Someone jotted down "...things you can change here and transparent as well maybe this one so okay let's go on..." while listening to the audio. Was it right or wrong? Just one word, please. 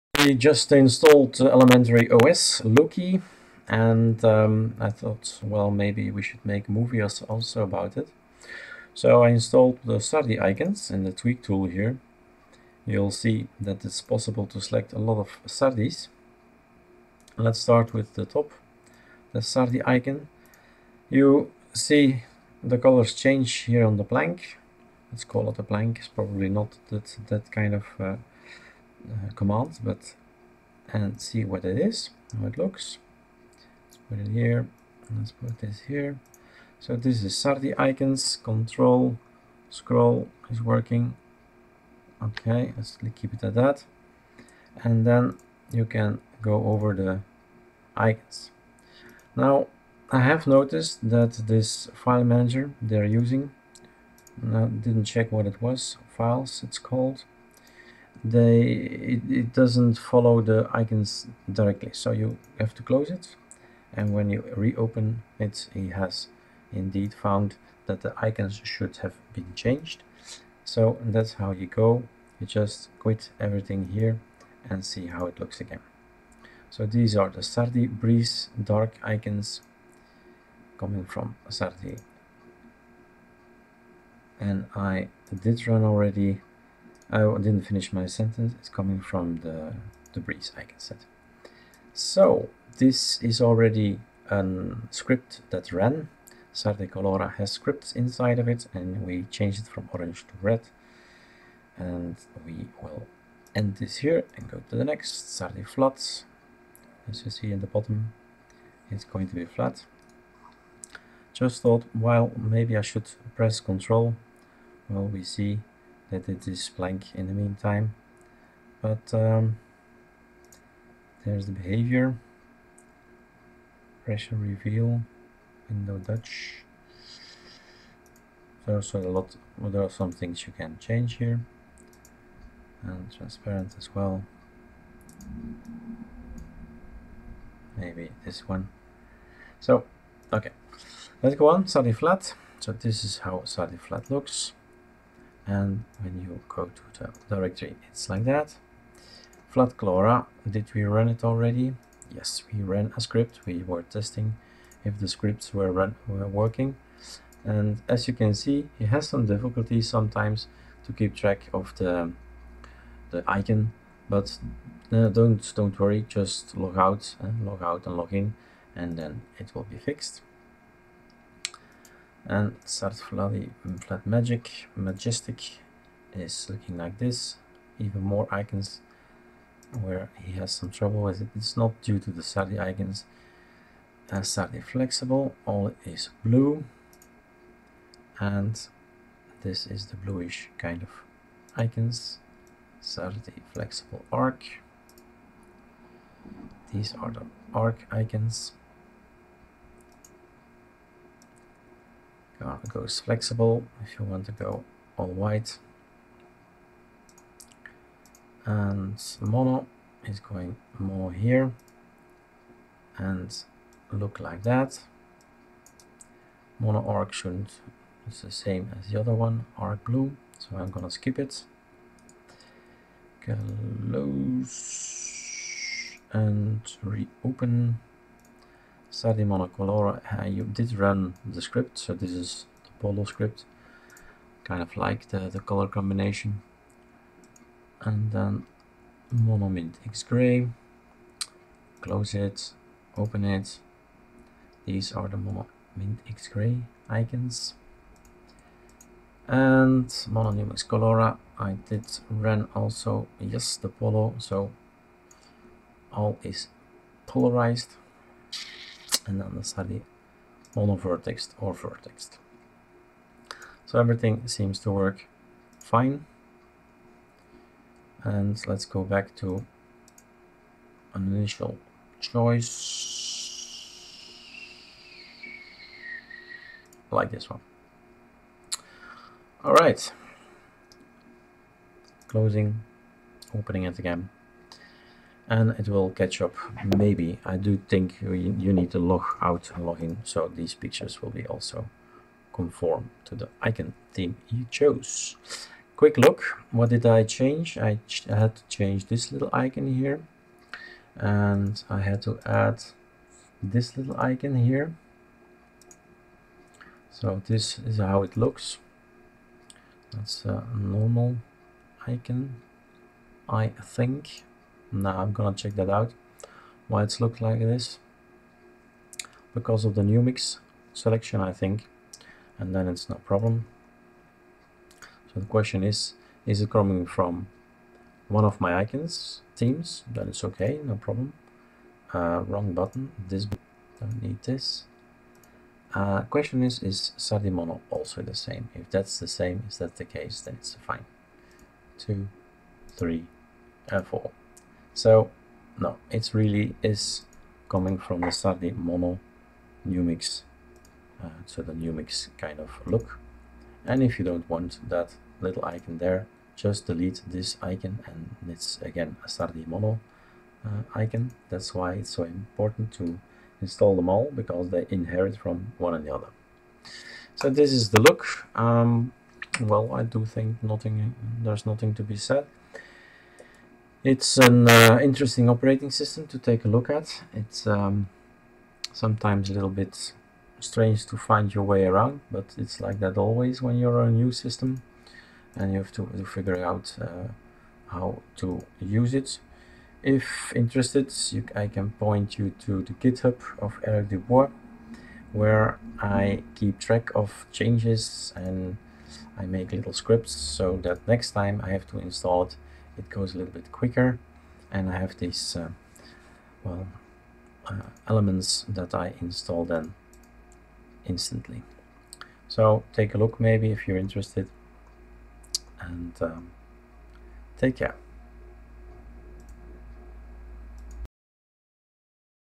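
right.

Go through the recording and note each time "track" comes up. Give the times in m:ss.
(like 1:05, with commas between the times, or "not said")
2:41, 6:36.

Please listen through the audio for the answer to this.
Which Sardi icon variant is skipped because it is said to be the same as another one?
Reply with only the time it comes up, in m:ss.
3:36.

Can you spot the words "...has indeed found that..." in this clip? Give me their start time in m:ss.
1:05.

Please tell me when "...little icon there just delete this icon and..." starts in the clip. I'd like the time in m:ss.
5:55.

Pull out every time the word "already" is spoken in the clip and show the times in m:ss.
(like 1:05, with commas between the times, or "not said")
1:25, 1:33, 2:31.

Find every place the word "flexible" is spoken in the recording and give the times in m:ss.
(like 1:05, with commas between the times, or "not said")
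3:04, 3:13, 3:22.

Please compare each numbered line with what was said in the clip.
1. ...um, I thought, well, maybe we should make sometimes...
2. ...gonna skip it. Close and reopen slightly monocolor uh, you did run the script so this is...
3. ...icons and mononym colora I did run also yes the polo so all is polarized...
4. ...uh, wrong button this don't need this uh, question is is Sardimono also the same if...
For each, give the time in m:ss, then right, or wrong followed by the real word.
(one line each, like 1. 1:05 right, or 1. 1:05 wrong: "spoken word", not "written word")
1. 0:04 wrong: "movies", not "sometimes"
2. 3:40 right
3. 4:06 right
4. 5:31 right.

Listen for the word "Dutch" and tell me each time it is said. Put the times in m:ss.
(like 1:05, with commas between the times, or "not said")
2:05.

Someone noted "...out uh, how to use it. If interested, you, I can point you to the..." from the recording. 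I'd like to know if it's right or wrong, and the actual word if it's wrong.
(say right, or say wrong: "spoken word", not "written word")
right.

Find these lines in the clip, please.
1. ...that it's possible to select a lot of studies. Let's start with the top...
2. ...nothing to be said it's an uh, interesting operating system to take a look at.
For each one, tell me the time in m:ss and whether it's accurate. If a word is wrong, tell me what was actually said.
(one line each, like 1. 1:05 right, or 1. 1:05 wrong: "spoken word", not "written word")
1. 0:13 right
2. 6:11 right.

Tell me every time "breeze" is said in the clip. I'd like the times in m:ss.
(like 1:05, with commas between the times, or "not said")
1:17, 1:30.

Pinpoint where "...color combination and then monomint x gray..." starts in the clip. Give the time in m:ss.
3:55.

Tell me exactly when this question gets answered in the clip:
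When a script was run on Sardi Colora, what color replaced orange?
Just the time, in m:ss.
1:40.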